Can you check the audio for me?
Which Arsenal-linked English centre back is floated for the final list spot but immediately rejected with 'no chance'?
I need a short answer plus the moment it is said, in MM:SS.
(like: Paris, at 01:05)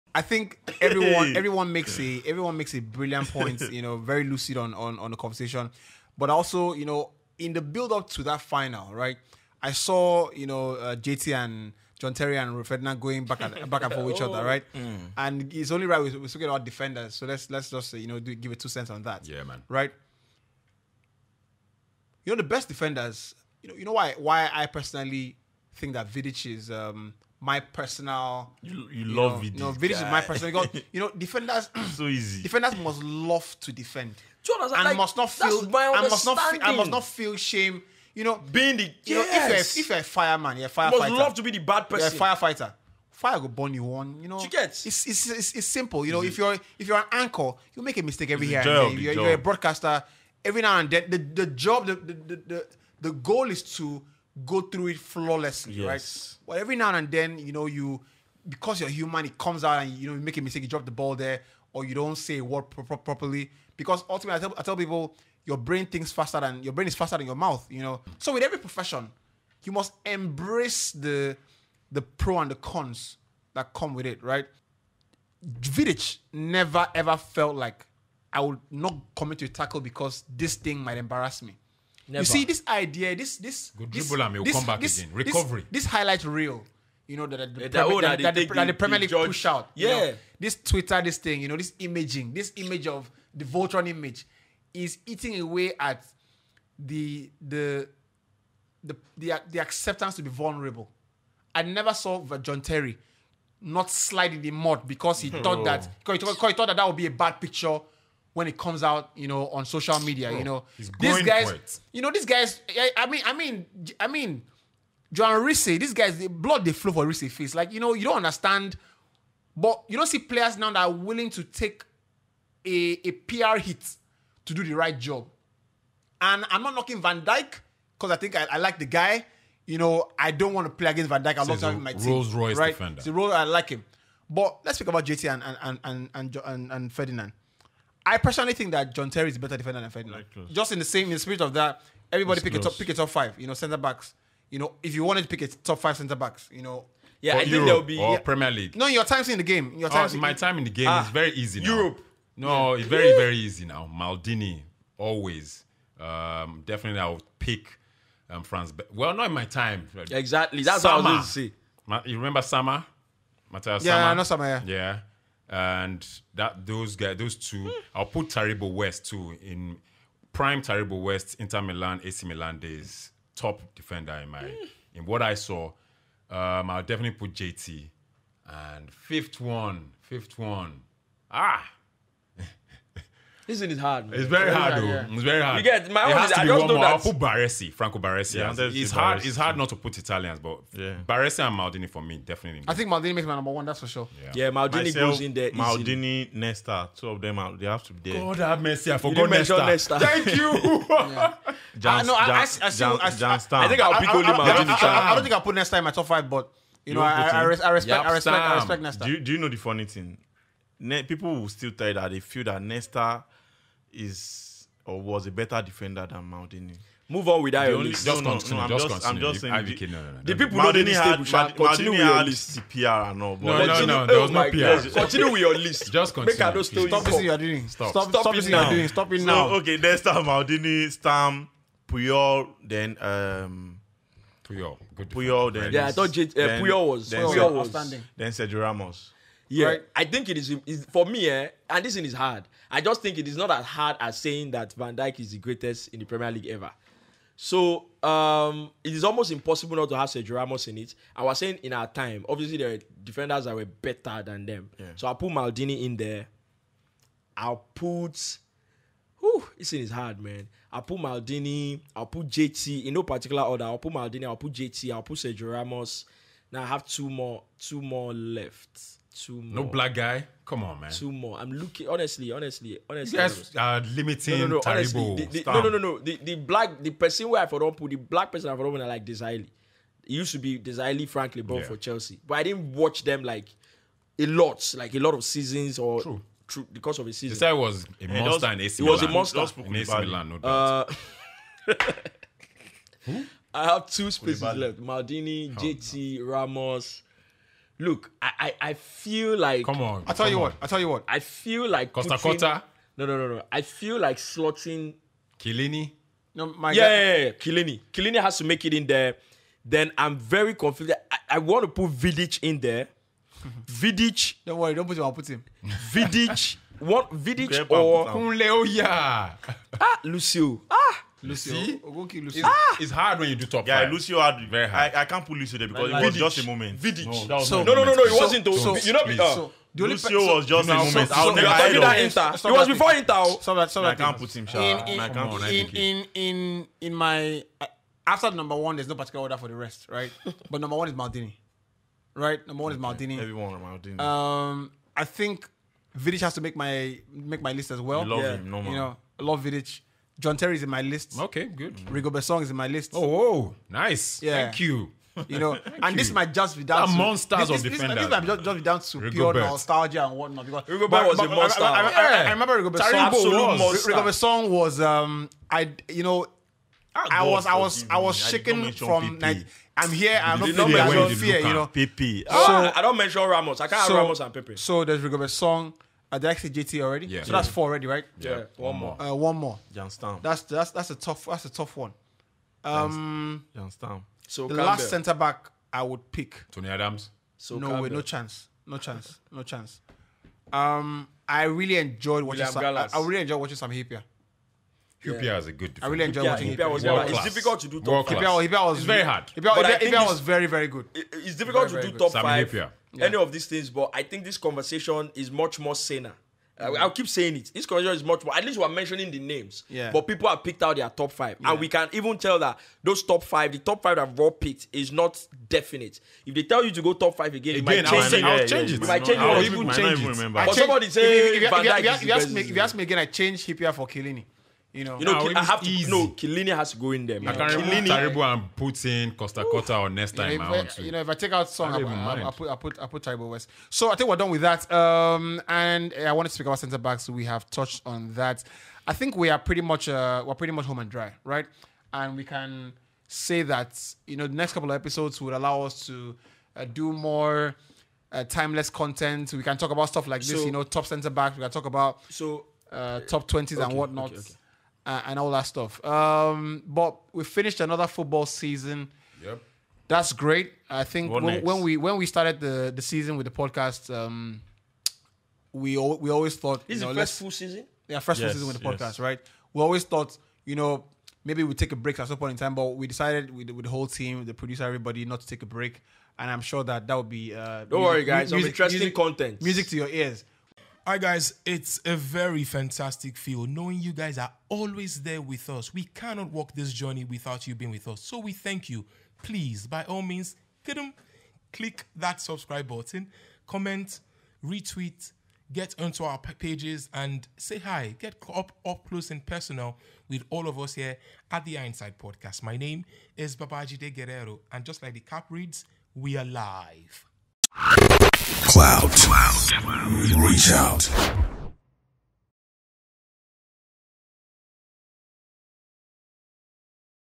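Tony Adams, at 06:26.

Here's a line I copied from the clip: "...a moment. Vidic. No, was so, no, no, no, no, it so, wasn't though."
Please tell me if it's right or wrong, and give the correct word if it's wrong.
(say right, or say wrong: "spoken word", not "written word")
right.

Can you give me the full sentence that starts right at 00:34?
Do And like, must not feel.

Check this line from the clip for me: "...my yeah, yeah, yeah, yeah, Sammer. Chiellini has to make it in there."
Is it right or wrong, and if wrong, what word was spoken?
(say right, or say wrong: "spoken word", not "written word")
wrong: "Chiellini", not "Sammer".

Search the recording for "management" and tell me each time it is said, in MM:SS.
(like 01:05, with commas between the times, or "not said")
not said.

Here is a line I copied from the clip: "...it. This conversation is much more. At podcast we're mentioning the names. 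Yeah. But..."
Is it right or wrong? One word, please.
wrong.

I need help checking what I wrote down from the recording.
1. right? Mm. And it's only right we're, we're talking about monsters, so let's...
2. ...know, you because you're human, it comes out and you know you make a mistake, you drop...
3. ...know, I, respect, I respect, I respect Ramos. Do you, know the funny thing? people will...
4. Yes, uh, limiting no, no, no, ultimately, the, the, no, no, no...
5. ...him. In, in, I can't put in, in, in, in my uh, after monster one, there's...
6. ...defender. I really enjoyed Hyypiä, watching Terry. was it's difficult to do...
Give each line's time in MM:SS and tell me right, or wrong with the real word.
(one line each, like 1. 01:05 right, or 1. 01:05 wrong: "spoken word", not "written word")
1. 00:14 wrong: "defenders", not "monsters"
2. 00:57 right
3. 03:26 wrong: "Nesta", not "Ramos"
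4. 04:33 wrong: "honestly", not "ultimately"
5. 05:34 wrong: "number", not "monster"
6. 06:35 wrong: "Hyypiä", not "Terry".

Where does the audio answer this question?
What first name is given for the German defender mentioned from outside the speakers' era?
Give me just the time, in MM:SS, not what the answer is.
02:43.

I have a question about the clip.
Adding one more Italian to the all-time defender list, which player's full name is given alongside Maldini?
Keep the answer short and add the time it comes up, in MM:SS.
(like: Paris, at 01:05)
Franco Baresi, at 03:07.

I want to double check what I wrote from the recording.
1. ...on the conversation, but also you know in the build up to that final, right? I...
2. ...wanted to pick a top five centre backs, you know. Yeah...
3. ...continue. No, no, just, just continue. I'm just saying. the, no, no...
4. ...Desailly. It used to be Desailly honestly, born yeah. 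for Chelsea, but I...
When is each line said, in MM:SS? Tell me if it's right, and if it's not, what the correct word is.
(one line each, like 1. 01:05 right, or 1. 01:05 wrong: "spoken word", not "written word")
1. 00:04 right
2. 02:25 right
3. 03:38 right
4. 04:39 wrong: "frankly", not "honestly".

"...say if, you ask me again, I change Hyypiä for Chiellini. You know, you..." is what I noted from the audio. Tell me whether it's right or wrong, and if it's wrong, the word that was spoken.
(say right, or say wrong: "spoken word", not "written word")
right.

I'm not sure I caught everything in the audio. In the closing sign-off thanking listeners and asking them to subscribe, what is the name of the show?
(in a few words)
Hindsight Podcast.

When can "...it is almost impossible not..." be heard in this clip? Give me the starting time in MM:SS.
04:08.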